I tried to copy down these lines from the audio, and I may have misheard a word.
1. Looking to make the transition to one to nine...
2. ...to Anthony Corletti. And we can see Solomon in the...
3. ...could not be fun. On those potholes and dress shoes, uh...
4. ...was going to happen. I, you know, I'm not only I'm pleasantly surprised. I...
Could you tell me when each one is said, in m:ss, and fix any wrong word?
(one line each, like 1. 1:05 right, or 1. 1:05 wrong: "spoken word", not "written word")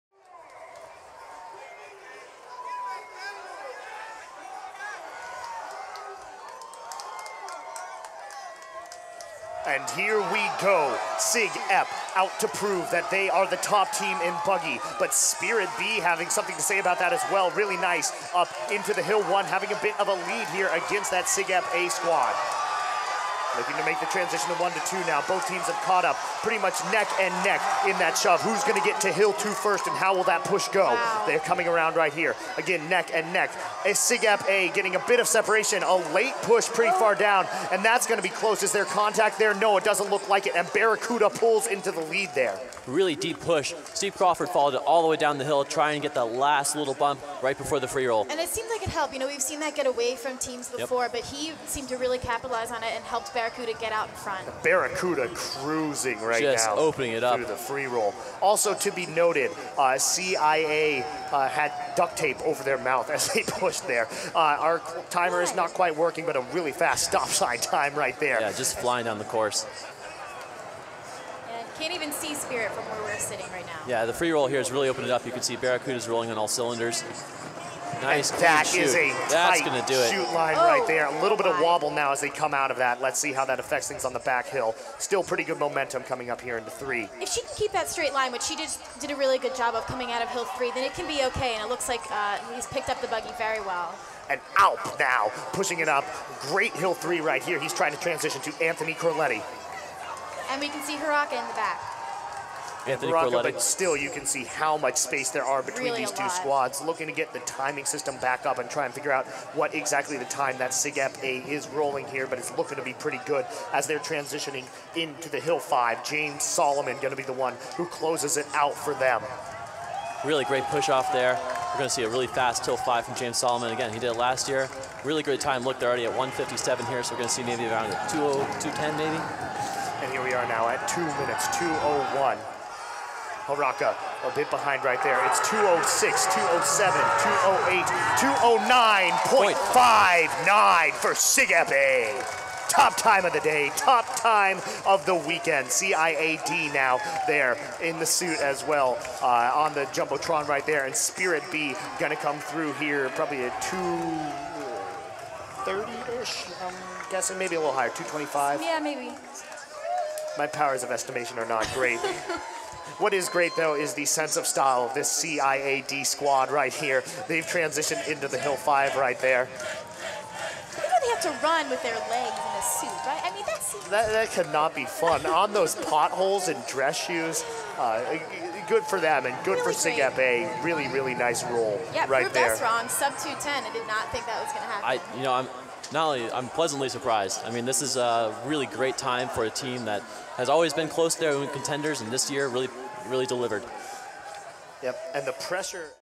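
1. 0:23 wrong: "two", not "nine"
2. 1:38 wrong: "Haraka", not "Solomon"
3. 2:54 right
4. 3:04 right.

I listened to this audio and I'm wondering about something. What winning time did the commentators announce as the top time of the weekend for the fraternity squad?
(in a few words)
2:09.59.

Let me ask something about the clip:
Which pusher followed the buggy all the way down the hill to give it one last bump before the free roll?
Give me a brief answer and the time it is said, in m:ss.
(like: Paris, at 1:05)
Steve Crawford, at 0:43.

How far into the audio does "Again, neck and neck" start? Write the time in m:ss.
0:32.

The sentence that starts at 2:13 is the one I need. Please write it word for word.
Haraka a bit behind right there.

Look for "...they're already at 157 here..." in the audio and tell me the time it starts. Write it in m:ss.
2:05.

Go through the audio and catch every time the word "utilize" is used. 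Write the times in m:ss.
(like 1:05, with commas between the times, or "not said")
not said.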